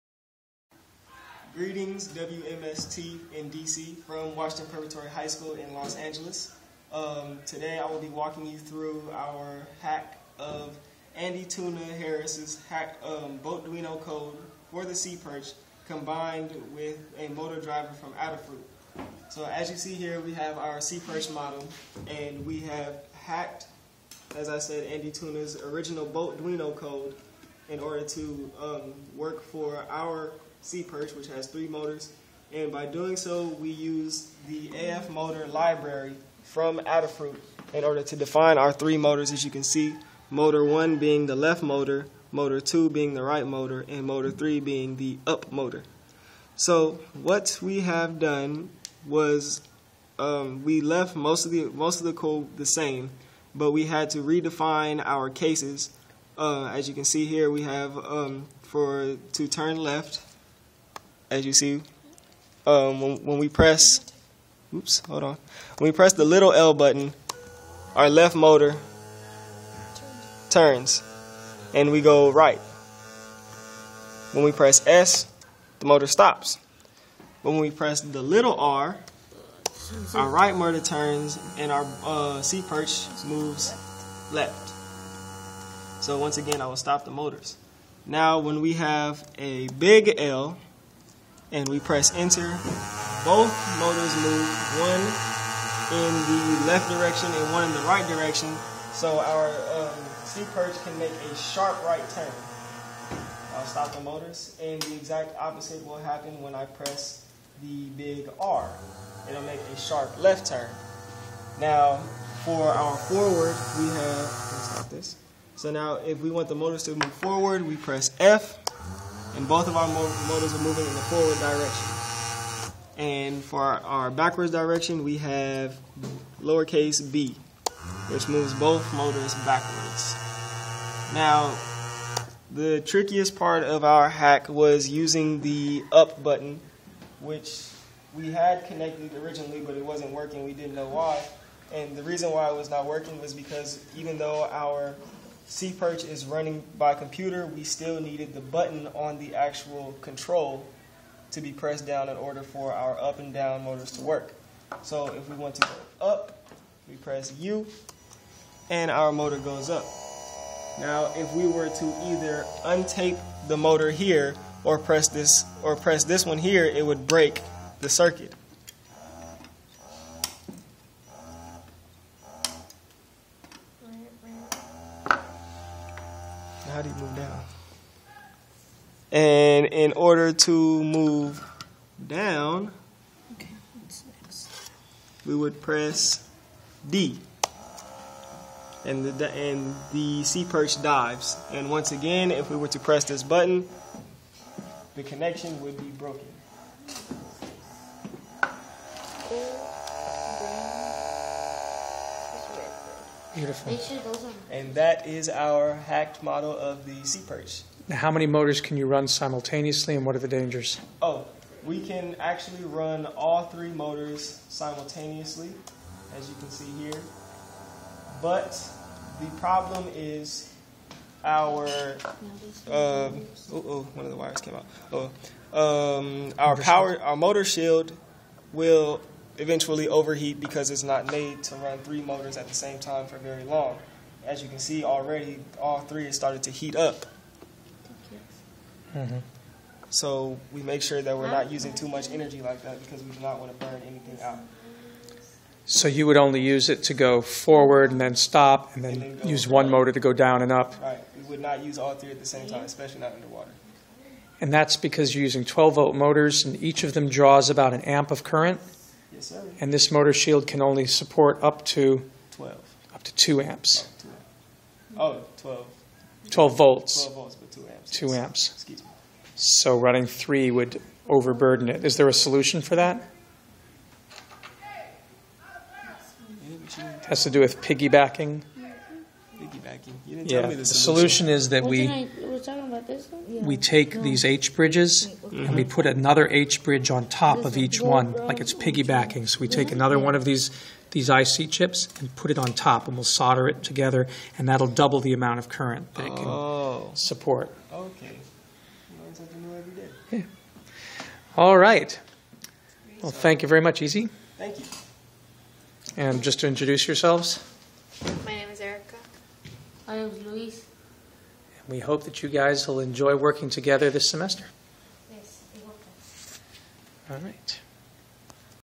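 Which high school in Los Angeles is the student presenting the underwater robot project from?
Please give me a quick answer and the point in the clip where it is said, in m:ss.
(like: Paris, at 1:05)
Washington Preparatory High School, at 0:04.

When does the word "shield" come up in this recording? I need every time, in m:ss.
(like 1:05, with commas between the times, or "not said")
3:47, 4:20.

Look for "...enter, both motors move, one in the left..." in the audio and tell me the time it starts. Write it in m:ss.
1:32.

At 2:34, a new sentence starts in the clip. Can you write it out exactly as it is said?
So if we want to go up, we press U and our motor goes up.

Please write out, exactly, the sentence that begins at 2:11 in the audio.
Now, the trickiest part of our hack was using the up button, which we had connected originally, but it wasn't working.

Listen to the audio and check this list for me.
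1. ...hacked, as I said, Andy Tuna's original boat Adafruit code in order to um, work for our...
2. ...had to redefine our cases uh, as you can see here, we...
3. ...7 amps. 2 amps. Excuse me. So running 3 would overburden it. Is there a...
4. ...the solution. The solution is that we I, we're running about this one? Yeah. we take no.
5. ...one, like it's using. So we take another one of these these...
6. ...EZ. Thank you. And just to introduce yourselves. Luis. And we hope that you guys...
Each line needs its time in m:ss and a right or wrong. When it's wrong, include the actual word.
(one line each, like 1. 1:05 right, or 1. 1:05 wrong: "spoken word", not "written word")
1. 0:23 wrong: "Duino", not "Adafruit"
2. 0:53 right
3. 4:27 wrong: "2", not "7"
4. 4:40 wrong: "talking", not "running"
5. 4:47 wrong: "piggybacking", not "using"
6. 5:03 right.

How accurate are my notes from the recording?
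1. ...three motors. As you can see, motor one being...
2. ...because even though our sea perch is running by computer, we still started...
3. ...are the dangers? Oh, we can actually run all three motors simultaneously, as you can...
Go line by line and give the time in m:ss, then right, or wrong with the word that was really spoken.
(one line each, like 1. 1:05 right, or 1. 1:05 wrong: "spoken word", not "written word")
1. 0:38 right
2. 2:23 wrong: "needed", not "started"
3. 3:30 right.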